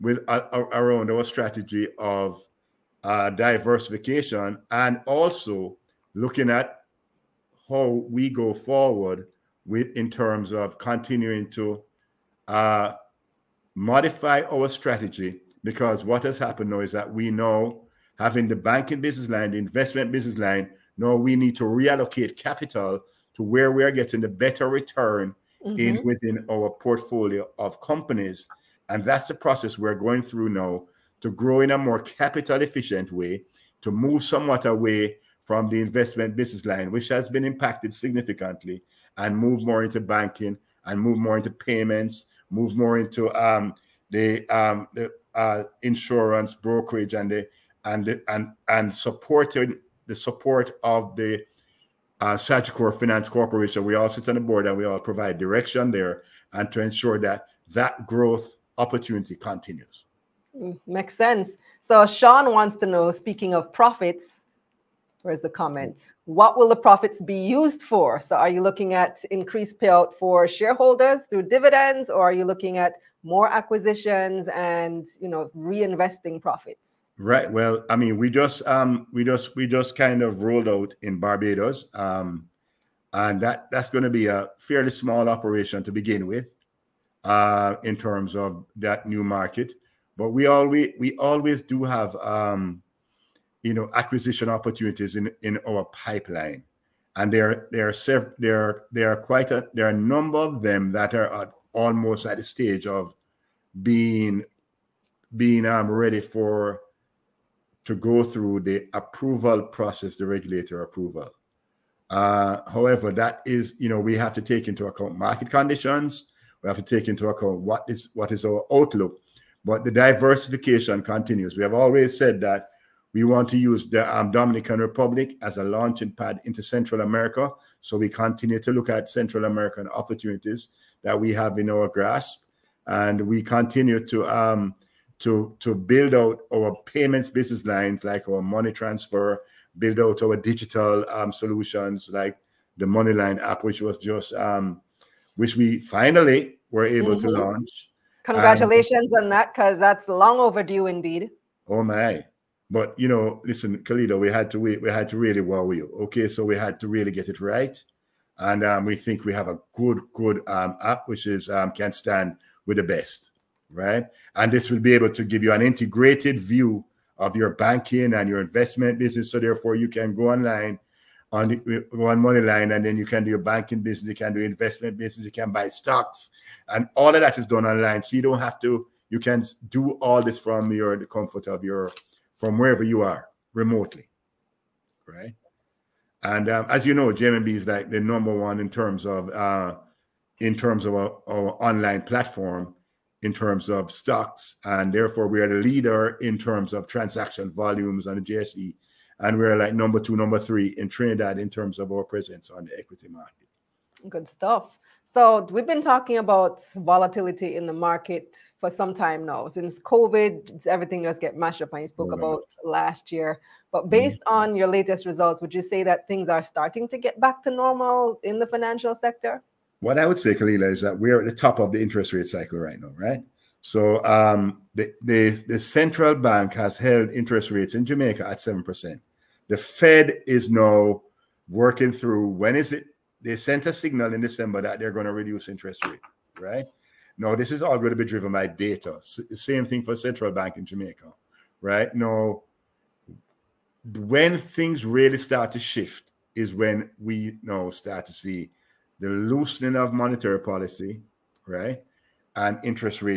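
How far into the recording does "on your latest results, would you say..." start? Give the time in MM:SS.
03:34.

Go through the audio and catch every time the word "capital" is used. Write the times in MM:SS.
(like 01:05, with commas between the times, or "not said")
00:22, 00:32.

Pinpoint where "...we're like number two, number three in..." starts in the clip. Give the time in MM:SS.
03:19.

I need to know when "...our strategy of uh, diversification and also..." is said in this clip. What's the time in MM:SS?
00:01.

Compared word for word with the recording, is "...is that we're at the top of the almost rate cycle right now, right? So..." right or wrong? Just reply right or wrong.
wrong.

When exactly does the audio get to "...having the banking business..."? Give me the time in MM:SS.
00:18.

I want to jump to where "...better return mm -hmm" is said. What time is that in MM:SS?
00:24.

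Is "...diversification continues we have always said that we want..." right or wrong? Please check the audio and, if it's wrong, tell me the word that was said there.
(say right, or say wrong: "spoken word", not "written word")
right.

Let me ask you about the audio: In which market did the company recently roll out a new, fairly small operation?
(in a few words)
Barbados.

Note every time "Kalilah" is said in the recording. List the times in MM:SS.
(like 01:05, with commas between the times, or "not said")
02:33, 03:40.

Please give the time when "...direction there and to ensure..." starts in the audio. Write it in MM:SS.
00:55.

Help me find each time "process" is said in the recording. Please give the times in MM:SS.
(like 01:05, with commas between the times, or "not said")
00:29, 01:49.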